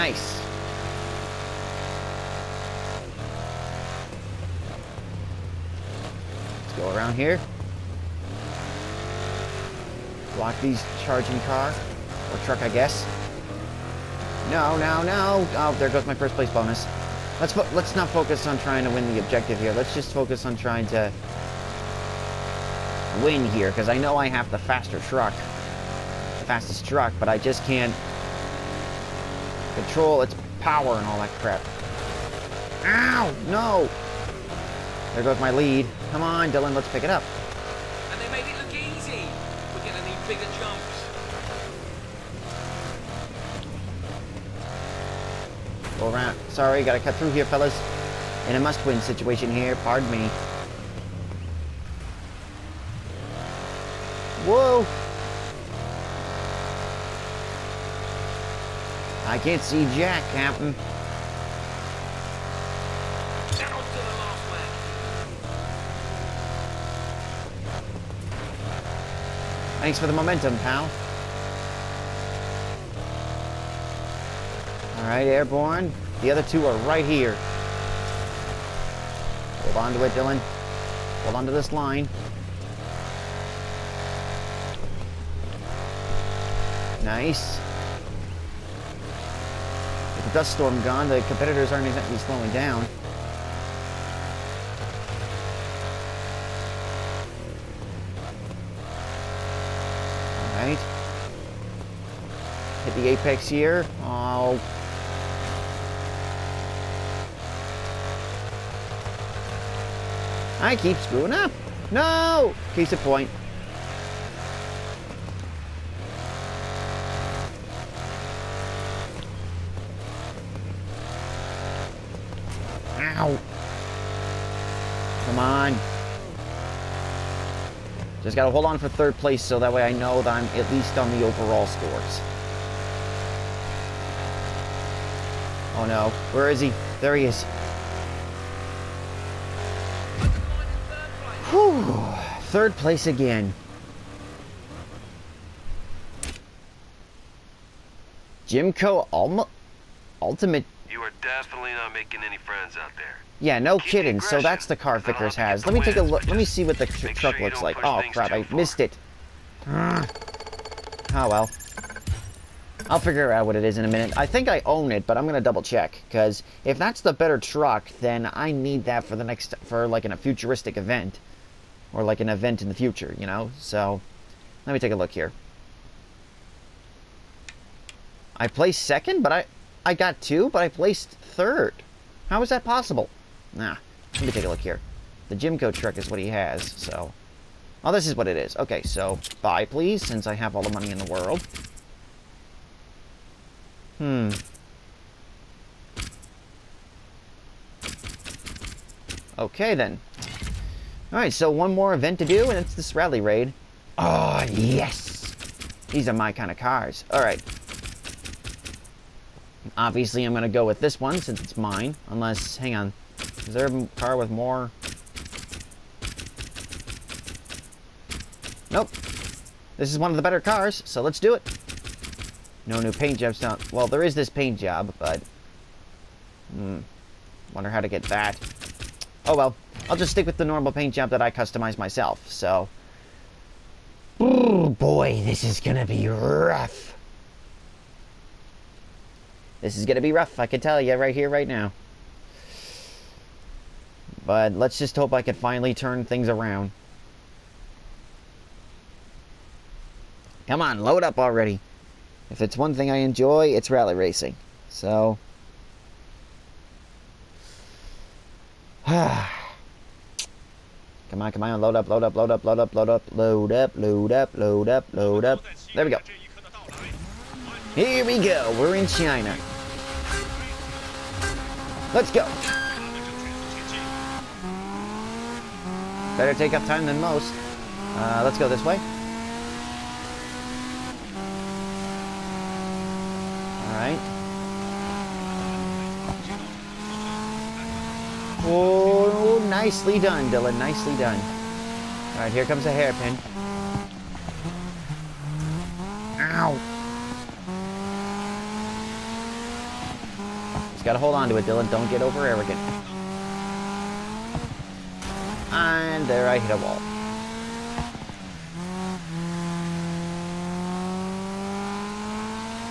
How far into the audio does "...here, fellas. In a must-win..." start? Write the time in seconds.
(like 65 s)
47 s.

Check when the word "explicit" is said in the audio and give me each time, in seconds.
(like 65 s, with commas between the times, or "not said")
not said.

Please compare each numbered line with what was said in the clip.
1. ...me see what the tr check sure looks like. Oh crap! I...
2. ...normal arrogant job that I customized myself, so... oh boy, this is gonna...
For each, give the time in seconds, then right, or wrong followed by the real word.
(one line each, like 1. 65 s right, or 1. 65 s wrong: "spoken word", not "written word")
1. 156 s wrong: "truck", not "check"
2. 230 s wrong: "paint", not "arrogant".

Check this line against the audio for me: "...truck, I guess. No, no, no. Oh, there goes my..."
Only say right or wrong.
right.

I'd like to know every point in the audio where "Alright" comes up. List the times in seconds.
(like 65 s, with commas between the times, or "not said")
201 s, 207 s, 283 s.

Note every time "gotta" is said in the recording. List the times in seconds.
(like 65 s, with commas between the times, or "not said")
46 s, 128 s, 300 s.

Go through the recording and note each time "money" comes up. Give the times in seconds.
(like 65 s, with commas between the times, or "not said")
190 s.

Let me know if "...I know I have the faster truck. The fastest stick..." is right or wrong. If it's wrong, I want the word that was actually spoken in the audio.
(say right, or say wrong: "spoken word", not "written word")
wrong: "truck", not "stick".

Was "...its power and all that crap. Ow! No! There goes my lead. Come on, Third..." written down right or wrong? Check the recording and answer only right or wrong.
wrong.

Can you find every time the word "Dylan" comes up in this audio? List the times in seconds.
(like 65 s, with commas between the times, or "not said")
36 s, 80 s, 290 s, 301 s.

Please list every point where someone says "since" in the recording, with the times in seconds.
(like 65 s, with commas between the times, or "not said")
190 s, 211 s.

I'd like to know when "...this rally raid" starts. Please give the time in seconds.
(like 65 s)
202 s.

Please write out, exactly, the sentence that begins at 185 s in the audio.
The Jimco truck is what he has, so...